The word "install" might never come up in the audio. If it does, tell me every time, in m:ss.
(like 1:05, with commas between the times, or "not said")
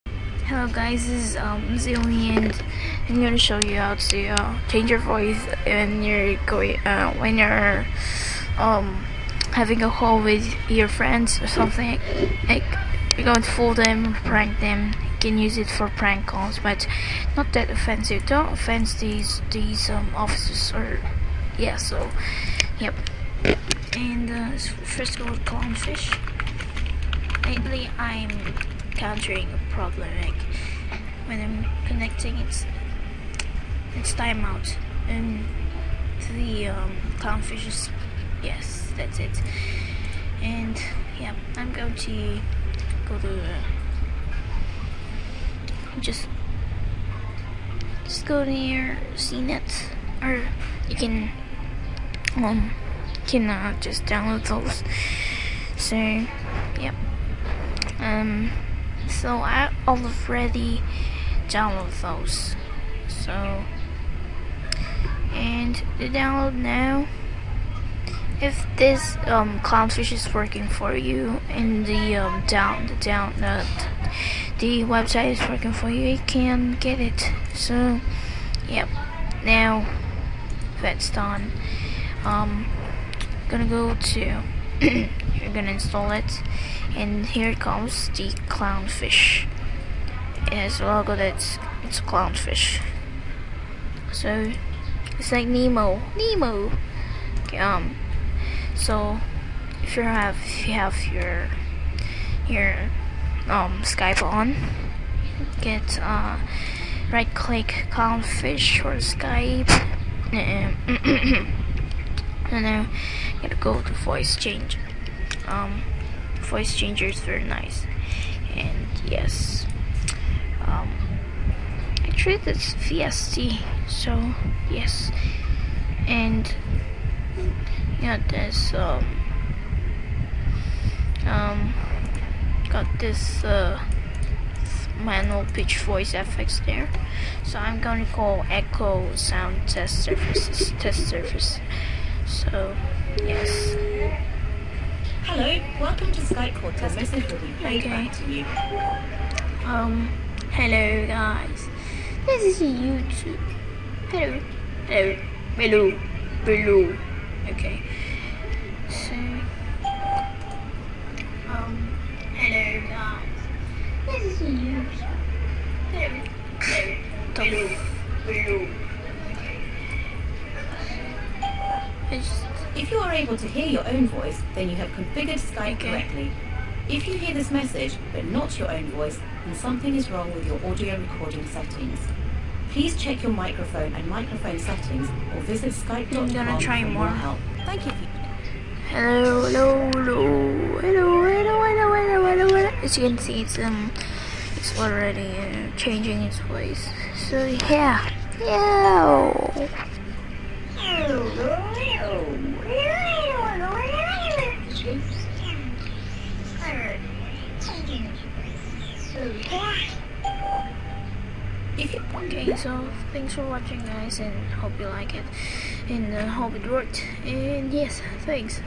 1:25.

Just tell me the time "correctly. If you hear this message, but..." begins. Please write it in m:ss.
2:55.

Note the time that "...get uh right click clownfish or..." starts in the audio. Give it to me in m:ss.
1:45.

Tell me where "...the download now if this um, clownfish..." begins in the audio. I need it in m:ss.
1:05.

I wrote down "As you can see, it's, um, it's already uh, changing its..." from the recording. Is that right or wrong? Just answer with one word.
right.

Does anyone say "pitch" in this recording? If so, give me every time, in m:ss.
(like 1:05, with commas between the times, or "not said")
2:15.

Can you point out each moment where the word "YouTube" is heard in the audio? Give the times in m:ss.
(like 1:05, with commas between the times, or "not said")
2:32, 2:44.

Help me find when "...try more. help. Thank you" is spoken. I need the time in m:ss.
3:06.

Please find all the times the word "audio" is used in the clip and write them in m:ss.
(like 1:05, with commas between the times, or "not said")
3:00.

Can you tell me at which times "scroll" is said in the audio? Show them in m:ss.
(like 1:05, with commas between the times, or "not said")
not said.